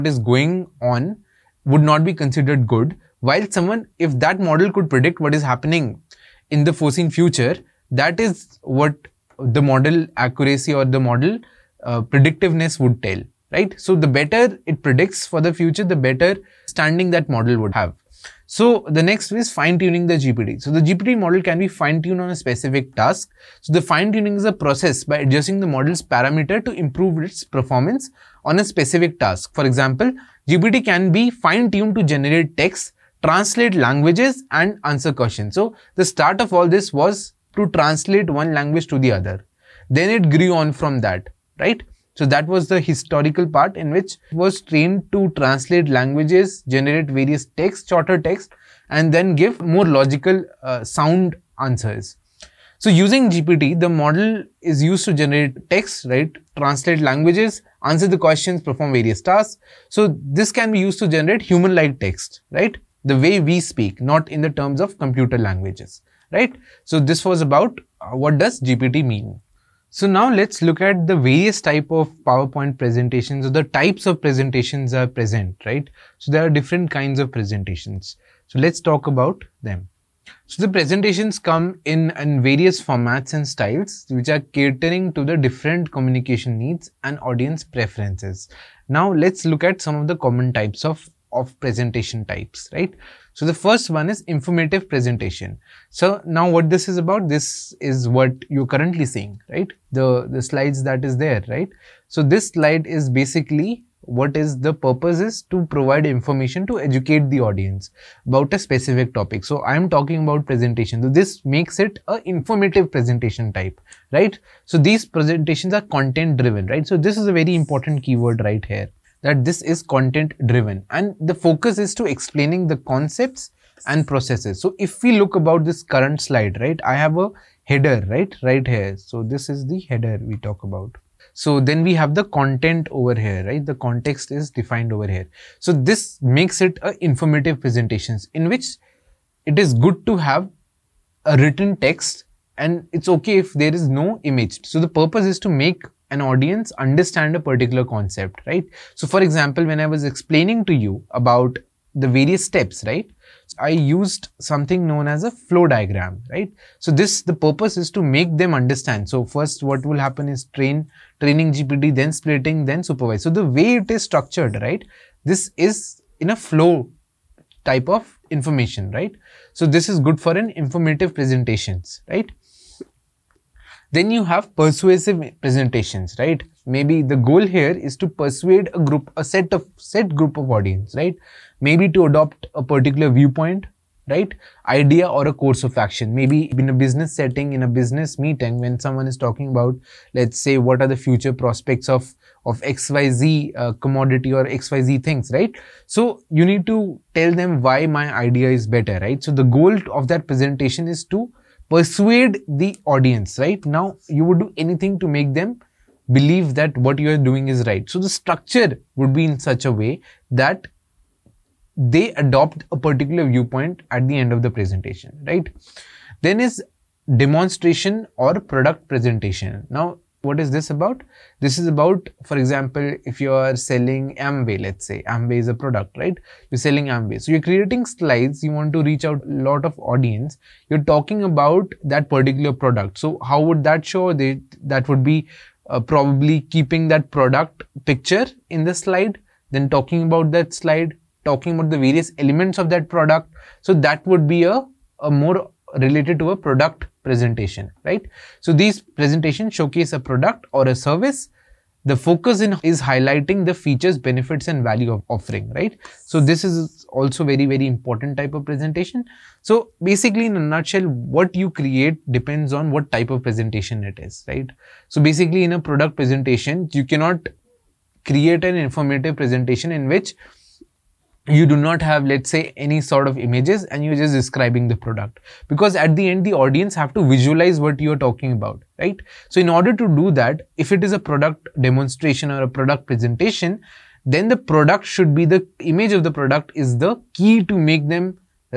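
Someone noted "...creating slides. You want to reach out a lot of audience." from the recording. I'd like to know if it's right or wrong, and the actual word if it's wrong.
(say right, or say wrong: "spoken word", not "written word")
right.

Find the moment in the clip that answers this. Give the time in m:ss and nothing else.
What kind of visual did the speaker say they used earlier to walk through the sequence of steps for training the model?
2:35.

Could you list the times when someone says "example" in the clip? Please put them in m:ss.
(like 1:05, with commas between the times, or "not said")
0:29, 2:29, 3:42.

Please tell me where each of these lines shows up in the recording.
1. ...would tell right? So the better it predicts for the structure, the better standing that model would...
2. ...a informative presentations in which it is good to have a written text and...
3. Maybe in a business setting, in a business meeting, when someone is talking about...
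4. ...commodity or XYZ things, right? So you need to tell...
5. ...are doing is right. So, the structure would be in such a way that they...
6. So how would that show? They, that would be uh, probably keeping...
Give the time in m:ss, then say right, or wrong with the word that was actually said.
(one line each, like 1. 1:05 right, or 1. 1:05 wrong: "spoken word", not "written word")
1. 0:12 wrong: "future", not "structure"
2. 2:16 right
3. 3:06 right
4. 3:13 right
5. 3:27 right
6. 3:52 right.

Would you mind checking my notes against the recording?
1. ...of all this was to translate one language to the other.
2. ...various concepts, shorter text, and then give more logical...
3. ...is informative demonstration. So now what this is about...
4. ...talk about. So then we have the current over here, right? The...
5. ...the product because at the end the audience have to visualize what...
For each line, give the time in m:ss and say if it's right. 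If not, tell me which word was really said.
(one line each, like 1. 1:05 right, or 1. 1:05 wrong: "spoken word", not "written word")
1. 0:36 right
2. 0:47 wrong: "texts", not "concepts"
3. 1:34 wrong: "presentation", not "demonstration"
4. 2:10 wrong: "content", not "current"
5. 4:34 right.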